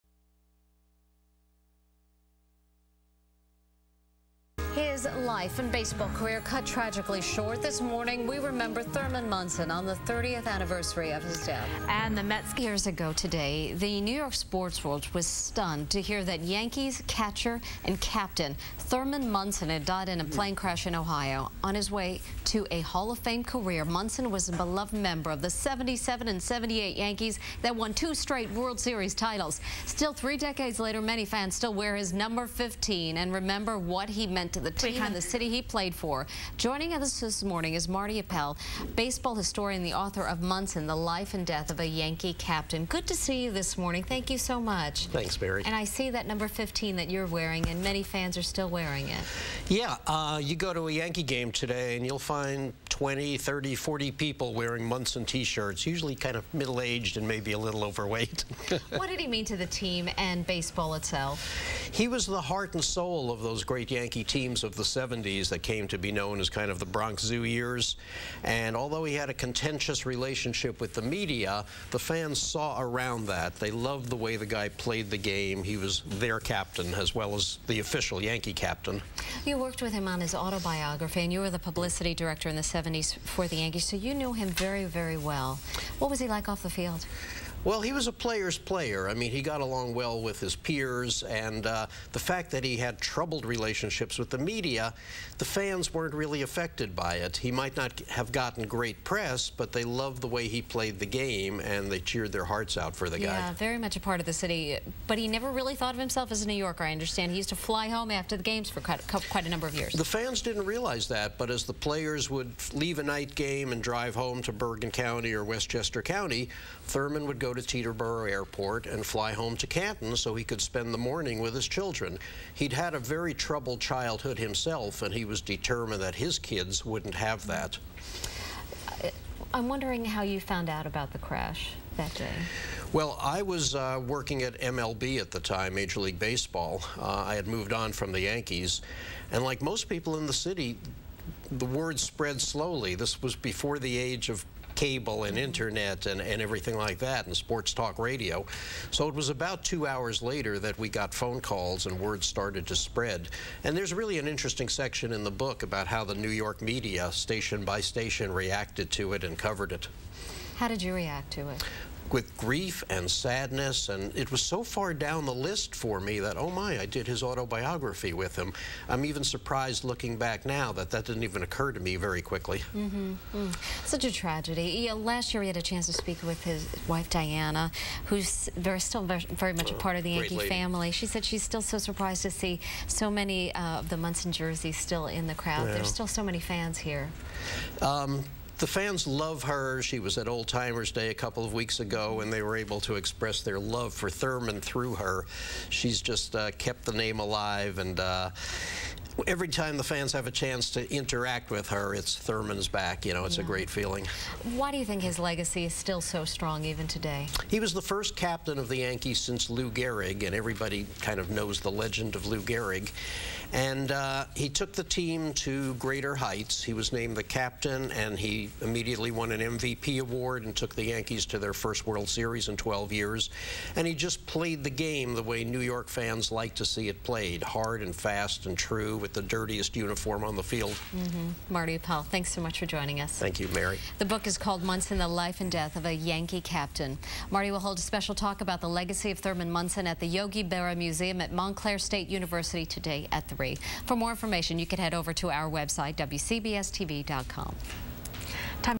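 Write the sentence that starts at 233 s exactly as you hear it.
The book is called Munson, The Life and Death of a Yankee Captain.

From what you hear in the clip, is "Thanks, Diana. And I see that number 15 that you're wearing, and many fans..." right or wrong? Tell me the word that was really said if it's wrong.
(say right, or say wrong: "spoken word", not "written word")
wrong: "Barry", not "Diana".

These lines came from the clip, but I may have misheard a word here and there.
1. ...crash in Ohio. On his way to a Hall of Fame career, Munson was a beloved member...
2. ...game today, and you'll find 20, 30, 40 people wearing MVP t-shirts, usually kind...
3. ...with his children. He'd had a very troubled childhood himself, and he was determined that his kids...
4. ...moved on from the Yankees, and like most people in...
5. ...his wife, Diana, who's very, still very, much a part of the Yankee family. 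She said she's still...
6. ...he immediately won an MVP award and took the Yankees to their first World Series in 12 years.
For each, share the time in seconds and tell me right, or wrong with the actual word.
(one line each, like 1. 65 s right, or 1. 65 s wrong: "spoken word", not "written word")
1. 20 s right
2. 51 s wrong: "Munson", not "MVP"
3. 121 s right
4. 137 s right
5. 176 s right
6. 218 s right.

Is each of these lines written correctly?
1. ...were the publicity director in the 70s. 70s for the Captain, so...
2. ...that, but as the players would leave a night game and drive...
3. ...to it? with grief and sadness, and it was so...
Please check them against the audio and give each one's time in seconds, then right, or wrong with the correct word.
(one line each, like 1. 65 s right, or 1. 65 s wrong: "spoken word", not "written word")
1. 81 s wrong: "Yankees", not "Captain"
2. 111 s right
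3. 161 s right.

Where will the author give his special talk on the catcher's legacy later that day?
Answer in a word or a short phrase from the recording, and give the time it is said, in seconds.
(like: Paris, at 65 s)
Yogi Berra Museum, at 240 s.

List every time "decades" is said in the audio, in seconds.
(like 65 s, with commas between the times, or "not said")
30 s.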